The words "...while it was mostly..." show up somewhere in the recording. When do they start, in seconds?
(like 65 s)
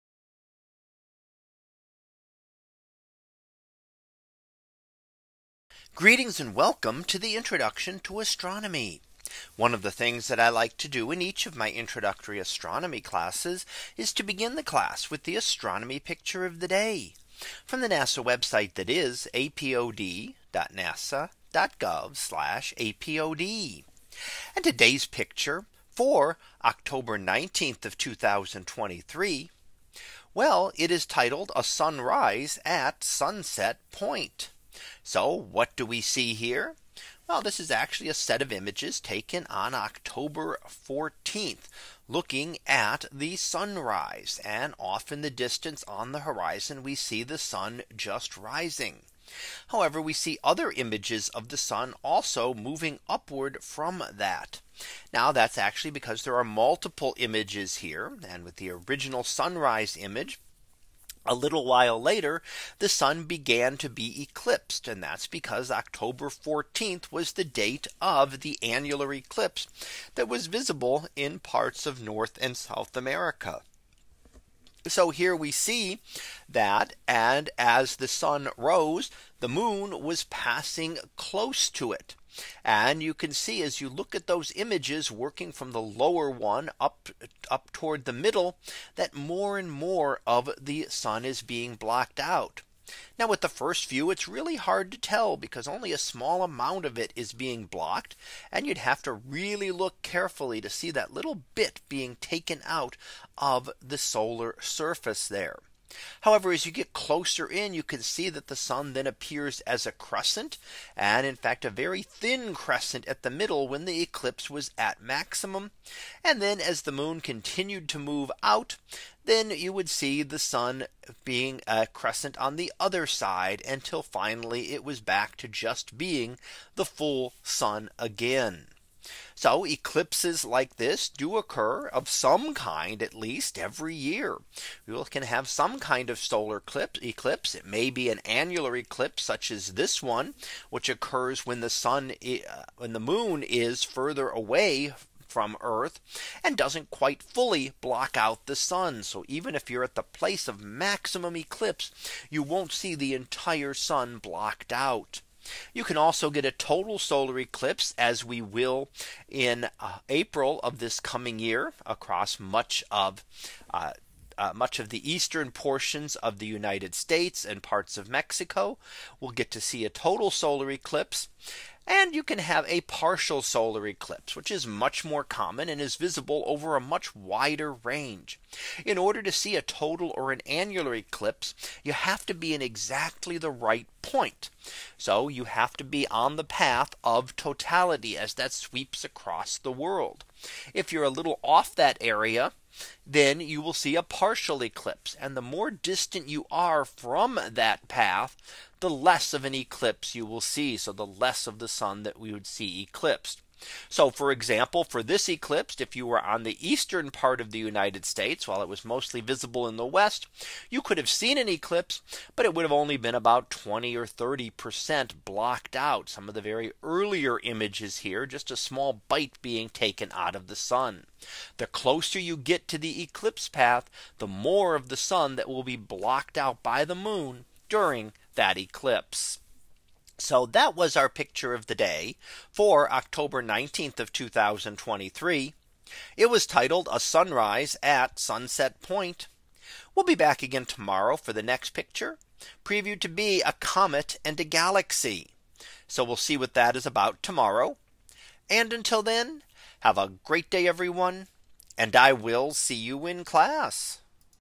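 208 s.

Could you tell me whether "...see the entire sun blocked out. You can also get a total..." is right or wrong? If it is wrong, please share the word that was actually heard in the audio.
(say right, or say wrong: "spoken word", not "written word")
right.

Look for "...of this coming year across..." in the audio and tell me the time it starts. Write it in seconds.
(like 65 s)
160 s.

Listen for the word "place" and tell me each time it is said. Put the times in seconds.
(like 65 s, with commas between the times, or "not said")
150 s.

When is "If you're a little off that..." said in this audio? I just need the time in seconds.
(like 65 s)
190 s.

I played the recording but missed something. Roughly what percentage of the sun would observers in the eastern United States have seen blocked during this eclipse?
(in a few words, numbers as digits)
20 or 30%.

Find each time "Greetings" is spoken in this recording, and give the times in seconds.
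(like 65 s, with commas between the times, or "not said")
5 s.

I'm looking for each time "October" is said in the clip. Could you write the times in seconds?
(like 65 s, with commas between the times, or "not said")
26 s, 39 s, 65 s, 232 s.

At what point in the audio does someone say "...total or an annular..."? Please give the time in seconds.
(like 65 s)
179 s.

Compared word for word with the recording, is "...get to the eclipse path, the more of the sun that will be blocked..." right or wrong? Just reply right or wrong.
right.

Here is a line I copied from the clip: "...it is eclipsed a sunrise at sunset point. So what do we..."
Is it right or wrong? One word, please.
wrong.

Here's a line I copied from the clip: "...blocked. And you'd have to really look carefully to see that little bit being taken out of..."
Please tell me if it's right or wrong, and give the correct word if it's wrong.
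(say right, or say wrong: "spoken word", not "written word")
right.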